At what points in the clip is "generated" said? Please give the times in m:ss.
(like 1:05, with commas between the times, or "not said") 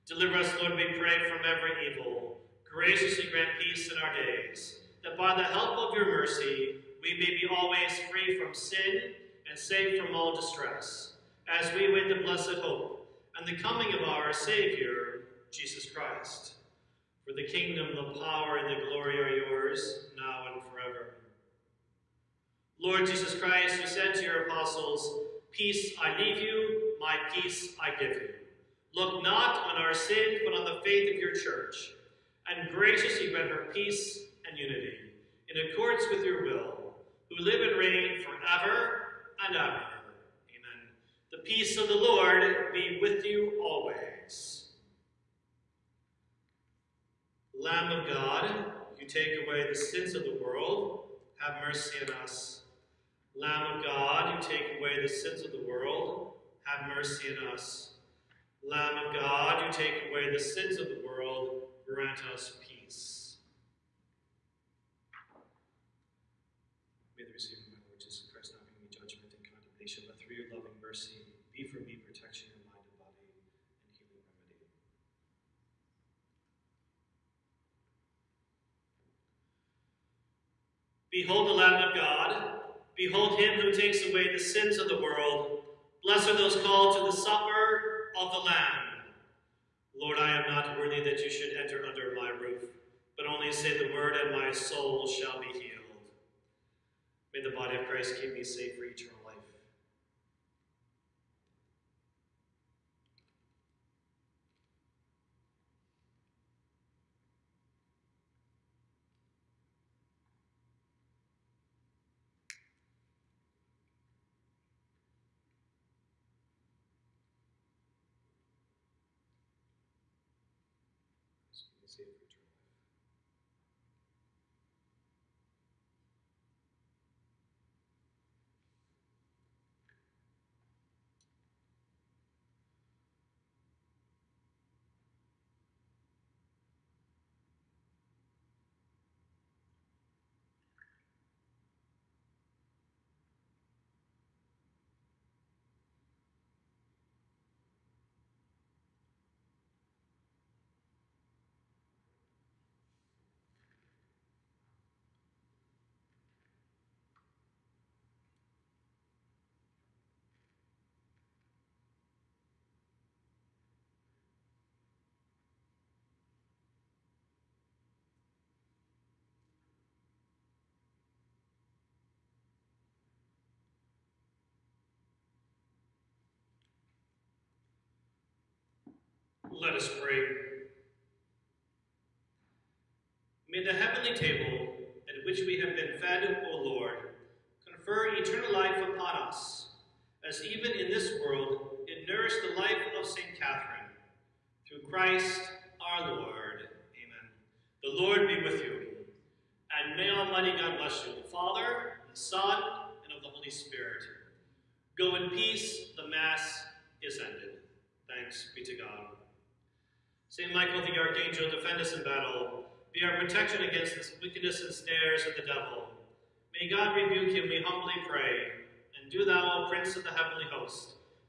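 not said.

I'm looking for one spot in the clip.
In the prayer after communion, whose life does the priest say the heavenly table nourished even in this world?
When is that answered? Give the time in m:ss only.
3:13.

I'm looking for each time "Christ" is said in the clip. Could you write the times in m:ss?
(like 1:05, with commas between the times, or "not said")
0:15, 0:23, 1:08, 1:37, 3:14.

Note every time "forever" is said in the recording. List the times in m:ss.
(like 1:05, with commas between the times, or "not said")
0:20, 0:38.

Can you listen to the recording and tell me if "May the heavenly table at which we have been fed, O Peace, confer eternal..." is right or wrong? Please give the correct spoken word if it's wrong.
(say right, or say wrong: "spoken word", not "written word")
wrong: "Lord", not "Peace".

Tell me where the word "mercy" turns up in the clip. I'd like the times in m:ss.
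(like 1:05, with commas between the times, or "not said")
0:06, 0:51, 0:56, 1:10.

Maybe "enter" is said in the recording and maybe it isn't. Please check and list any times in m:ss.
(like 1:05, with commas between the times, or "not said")
1:31.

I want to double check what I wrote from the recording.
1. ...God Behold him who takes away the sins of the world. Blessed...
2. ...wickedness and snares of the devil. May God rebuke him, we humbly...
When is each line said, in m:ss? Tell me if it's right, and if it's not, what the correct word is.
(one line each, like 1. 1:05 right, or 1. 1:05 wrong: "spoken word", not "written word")
1. 1:21 right
2. 3:34 right.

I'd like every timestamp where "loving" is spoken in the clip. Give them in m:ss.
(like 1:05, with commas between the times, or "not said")
1:10.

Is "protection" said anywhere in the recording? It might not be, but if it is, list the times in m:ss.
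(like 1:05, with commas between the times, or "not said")
1:11, 3:33.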